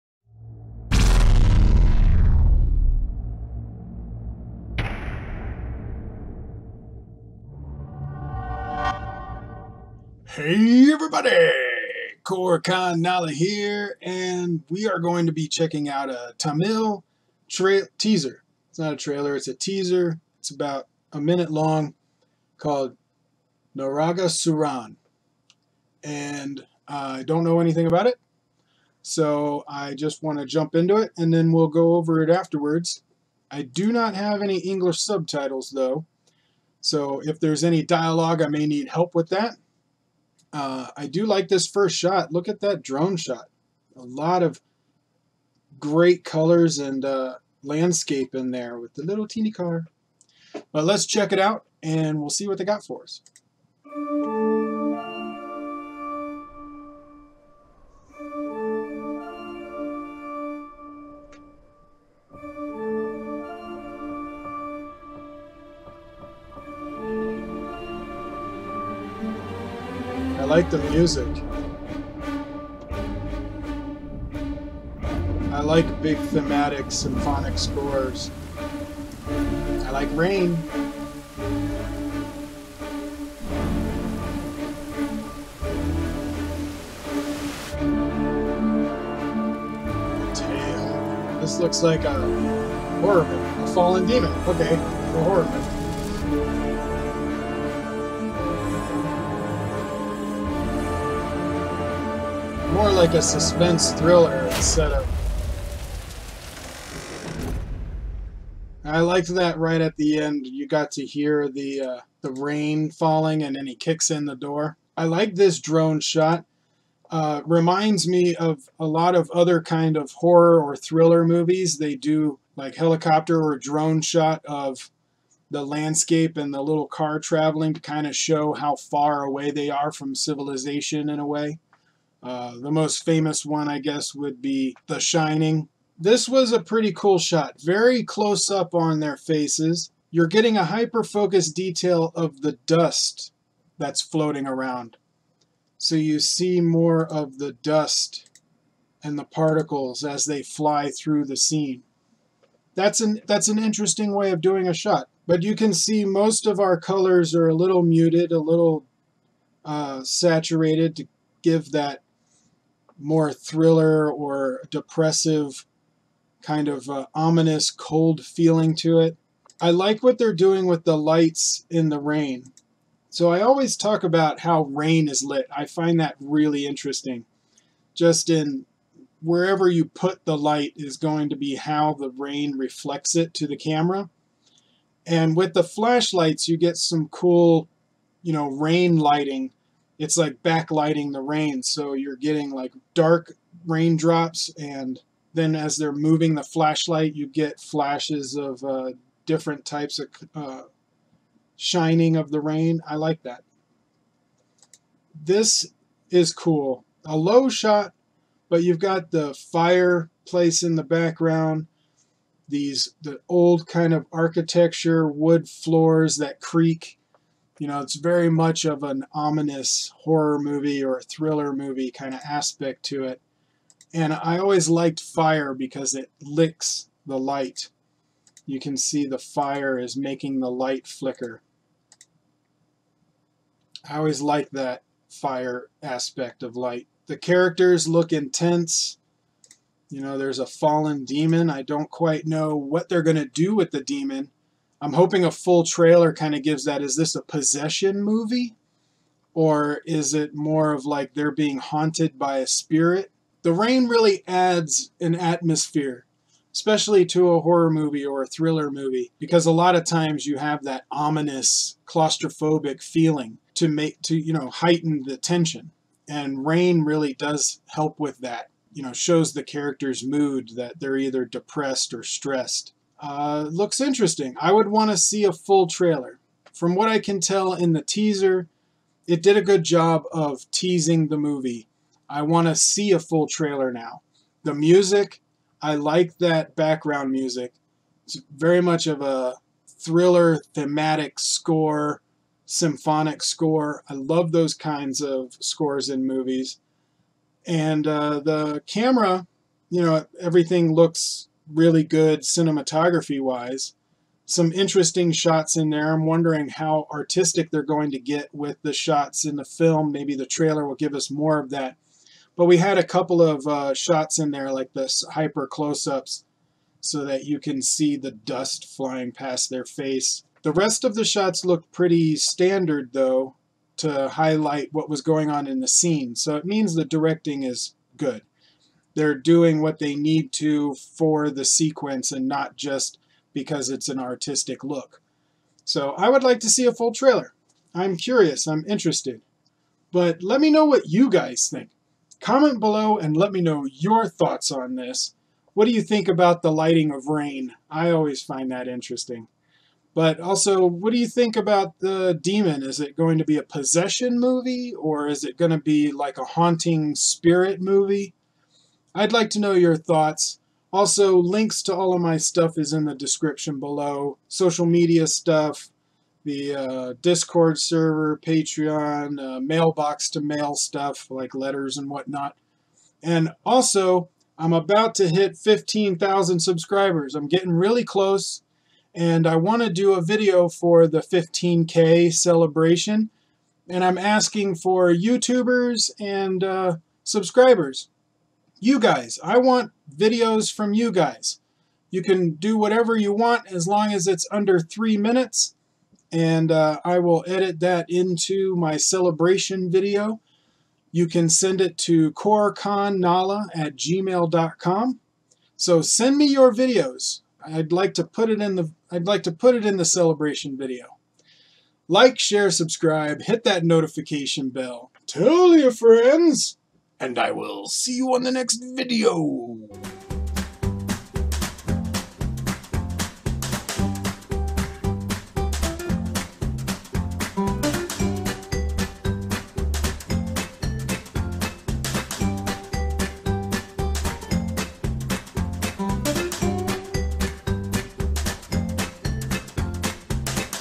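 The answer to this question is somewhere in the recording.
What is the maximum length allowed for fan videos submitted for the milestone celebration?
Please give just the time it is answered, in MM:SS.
06:34.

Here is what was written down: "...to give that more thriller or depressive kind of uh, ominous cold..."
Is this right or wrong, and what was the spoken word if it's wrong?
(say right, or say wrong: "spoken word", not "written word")
right.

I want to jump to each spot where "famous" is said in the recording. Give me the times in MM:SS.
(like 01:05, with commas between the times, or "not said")
02:13.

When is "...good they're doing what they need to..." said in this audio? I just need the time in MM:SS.
05:27.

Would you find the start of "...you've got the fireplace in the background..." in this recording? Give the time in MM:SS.
03:28.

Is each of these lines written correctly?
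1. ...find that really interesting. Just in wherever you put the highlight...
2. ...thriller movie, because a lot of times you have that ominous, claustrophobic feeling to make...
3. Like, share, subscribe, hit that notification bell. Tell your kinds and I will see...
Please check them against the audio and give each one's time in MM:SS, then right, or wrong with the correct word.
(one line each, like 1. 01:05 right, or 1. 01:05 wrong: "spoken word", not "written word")
1. 02:55 wrong: "light", not "highlight"
2. 04:18 right
3. 06:51 wrong: "friends", not "kinds".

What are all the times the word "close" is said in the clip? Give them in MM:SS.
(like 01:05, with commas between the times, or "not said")
02:18, 05:15, 06:17.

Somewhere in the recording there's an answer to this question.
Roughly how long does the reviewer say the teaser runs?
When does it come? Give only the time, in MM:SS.
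00:20.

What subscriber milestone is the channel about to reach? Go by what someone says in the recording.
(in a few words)
15,000.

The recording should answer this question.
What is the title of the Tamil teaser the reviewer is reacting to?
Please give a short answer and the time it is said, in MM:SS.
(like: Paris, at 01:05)
Naragasooran, at 00:23.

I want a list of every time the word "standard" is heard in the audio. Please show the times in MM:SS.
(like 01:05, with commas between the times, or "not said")
05:22.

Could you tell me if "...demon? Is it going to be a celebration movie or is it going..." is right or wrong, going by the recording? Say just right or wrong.
wrong.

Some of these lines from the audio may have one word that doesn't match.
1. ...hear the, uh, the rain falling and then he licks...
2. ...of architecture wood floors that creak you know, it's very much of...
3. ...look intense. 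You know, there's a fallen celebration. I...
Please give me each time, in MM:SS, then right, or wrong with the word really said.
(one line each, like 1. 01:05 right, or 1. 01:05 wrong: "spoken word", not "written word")
1. 01:51 wrong: "kicks", not "licks"
2. 03:33 right
3. 03:57 wrong: "demon", not "celebration".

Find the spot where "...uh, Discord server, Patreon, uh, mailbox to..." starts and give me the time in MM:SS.
06:06.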